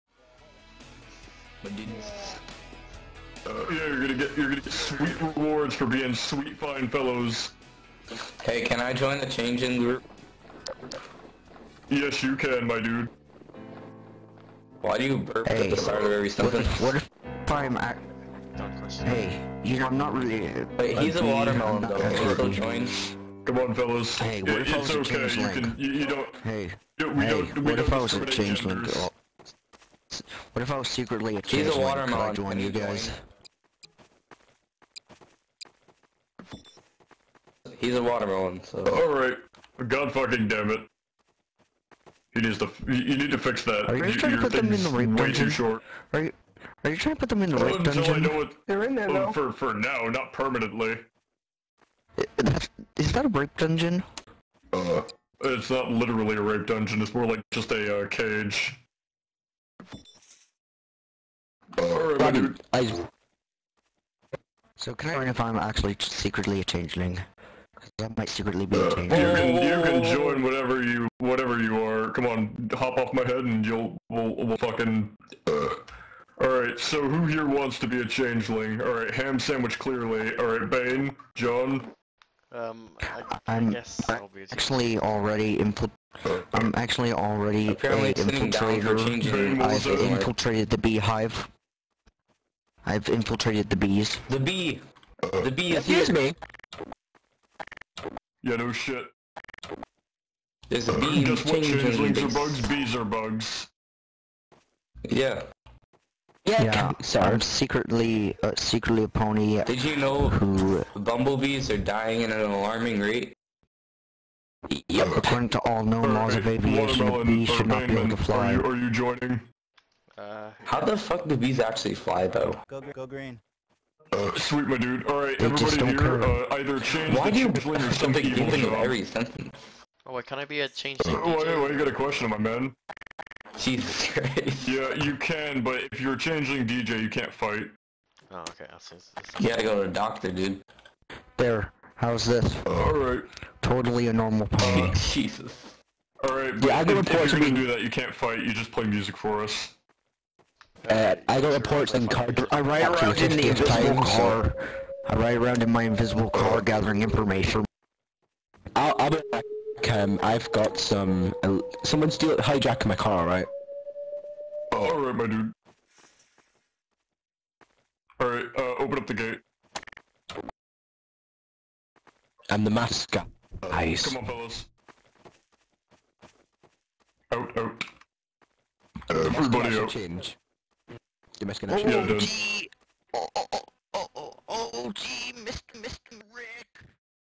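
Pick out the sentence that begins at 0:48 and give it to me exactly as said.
I know it, They're in there now.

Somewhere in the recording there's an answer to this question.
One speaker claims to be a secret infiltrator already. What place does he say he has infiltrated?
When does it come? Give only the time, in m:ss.
1:30.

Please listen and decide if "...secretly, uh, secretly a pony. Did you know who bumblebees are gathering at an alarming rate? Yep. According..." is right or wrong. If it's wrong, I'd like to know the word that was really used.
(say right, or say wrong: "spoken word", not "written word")
wrong: "dying", not "gathering".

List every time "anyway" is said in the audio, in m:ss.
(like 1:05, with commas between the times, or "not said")
2:11.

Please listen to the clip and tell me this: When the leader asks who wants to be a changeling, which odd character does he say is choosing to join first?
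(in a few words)
Ham sandwich.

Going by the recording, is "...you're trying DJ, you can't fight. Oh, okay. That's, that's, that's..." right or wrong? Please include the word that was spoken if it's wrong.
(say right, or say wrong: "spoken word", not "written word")
wrong: "changing", not "trying".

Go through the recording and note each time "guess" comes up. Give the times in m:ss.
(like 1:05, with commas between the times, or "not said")
1:23, 1:41.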